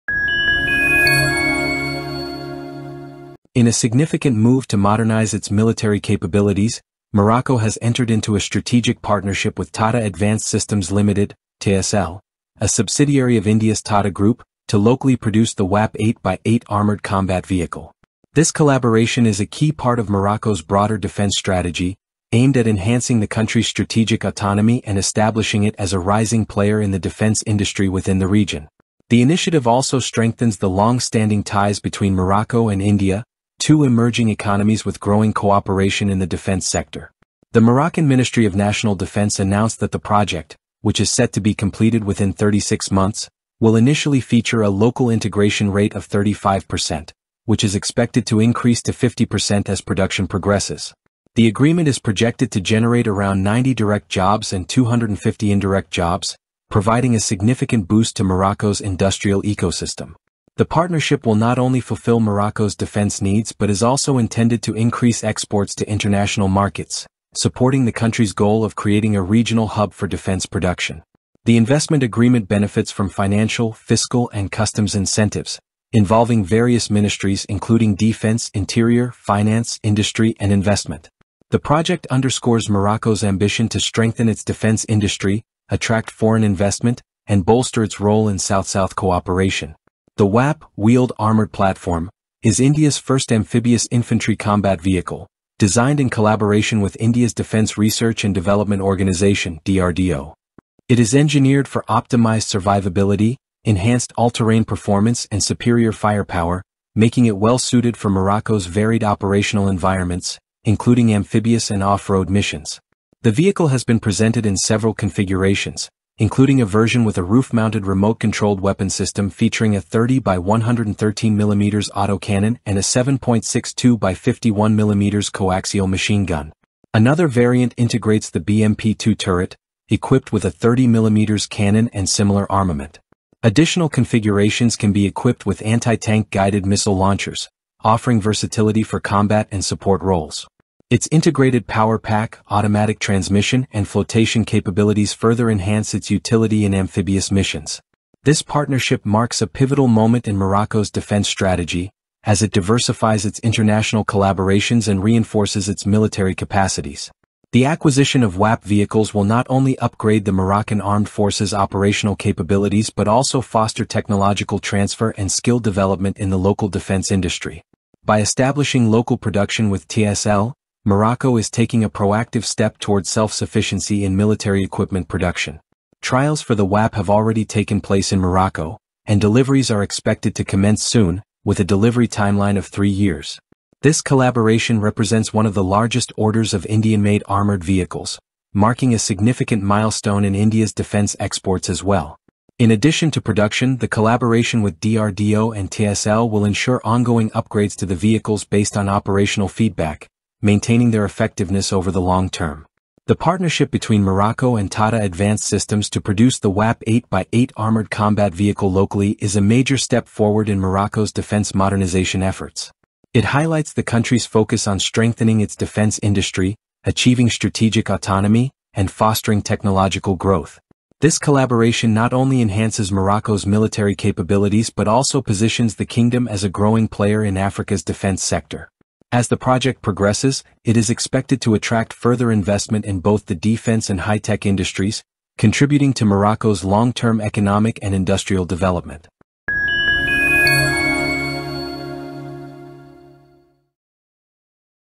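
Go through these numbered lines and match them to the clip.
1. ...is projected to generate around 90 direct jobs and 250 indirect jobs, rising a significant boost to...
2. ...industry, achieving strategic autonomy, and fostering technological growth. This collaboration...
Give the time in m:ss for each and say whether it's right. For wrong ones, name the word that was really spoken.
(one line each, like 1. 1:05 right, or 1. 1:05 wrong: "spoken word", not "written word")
1. 0:51 wrong: "providing", not "rising"
2. 3:36 right.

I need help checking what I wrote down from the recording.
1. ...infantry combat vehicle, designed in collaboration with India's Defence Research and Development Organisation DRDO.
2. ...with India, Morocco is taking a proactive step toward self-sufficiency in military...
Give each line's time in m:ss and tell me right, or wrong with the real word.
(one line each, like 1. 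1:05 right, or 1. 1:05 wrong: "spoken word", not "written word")
1. 1:33 right
2. 2:49 wrong: "TASL", not "India".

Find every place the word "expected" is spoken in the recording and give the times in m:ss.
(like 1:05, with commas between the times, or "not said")
0:47, 2:59, 3:50.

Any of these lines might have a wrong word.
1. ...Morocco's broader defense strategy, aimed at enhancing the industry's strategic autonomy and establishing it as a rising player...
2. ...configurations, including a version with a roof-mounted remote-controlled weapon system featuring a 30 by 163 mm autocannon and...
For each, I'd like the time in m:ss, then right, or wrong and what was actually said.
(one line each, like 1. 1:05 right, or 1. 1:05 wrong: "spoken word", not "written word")
1. 0:20 wrong: "country", not "industry"
2. 1:54 wrong: "113", not "163".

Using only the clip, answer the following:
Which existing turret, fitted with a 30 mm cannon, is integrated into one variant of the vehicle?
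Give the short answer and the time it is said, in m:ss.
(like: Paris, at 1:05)
BMP-2, at 2:08.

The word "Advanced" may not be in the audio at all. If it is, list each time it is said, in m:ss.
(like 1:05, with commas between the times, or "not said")
0:10, 3:25.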